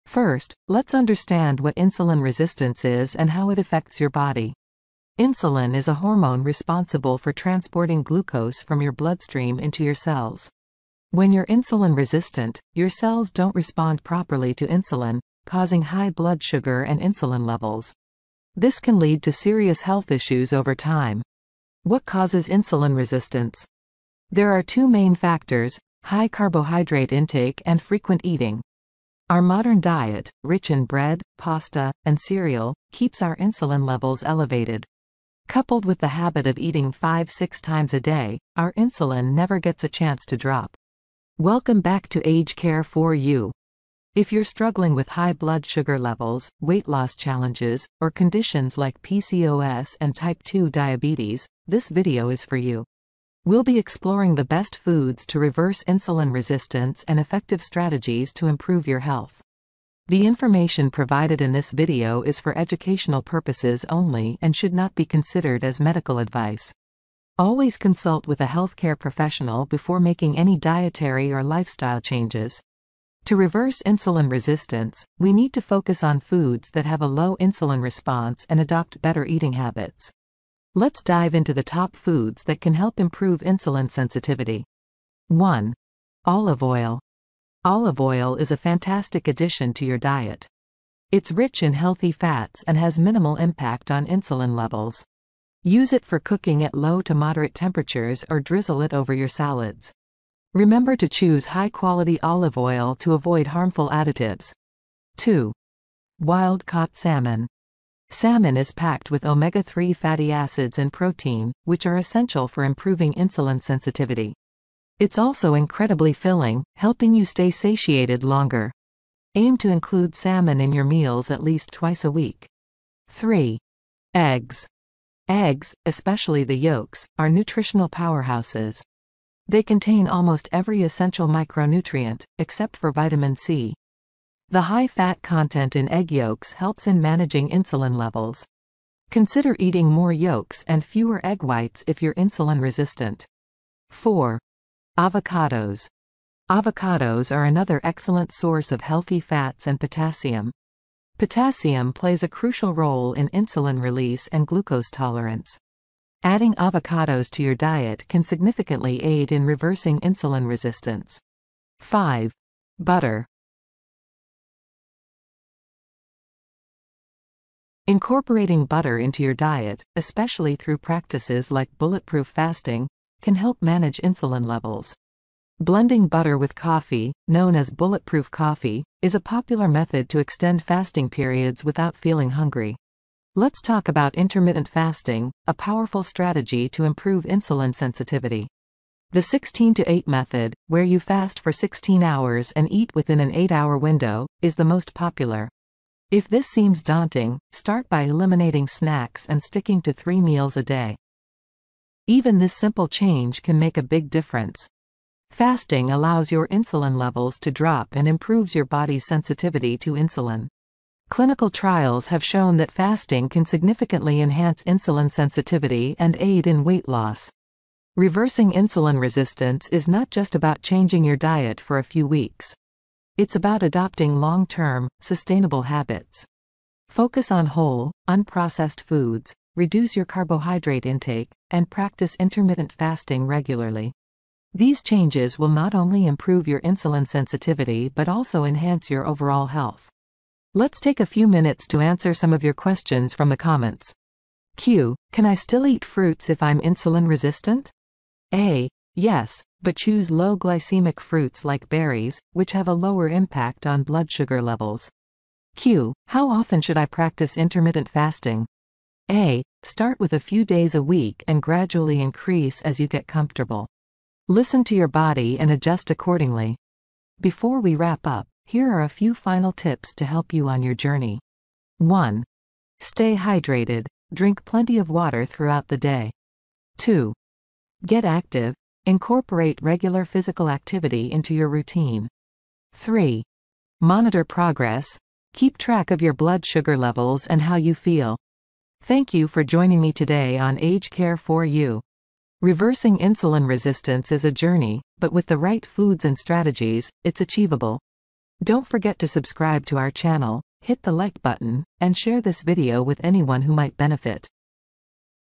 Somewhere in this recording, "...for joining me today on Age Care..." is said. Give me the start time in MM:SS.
04:49.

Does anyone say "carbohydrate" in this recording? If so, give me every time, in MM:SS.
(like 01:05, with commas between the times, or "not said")
00:26, 03:50.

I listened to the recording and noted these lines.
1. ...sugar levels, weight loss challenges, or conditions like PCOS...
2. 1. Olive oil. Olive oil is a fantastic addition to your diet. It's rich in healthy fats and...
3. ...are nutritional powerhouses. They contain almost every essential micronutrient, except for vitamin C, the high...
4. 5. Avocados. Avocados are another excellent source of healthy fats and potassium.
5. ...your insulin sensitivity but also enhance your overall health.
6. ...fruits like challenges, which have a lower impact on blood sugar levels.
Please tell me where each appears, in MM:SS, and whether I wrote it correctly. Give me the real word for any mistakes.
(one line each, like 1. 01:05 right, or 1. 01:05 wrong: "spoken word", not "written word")
1. 00:45 right
2. 01:25 right
3. 02:07 right
4. 02:23 wrong: "4", not "5"
5. 03:56 right
6. 04:10 wrong: "berries", not "challenges".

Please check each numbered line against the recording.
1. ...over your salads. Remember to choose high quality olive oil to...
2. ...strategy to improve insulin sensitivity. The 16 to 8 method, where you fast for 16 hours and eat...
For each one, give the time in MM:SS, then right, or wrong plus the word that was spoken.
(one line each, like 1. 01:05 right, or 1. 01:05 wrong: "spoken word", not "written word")
1. 01:38 right
2. 03:06 right.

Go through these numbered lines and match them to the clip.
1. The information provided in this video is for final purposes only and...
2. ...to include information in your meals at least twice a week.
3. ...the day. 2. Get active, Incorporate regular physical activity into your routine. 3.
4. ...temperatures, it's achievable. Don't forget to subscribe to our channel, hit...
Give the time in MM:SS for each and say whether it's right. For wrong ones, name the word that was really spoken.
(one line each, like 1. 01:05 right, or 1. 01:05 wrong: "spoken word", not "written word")
1. 01:00 wrong: "educational", not "final"
2. 01:59 wrong: "salmon", not "information"
3. 04:35 right
4. 04:56 wrong: "strategies", not "temperatures".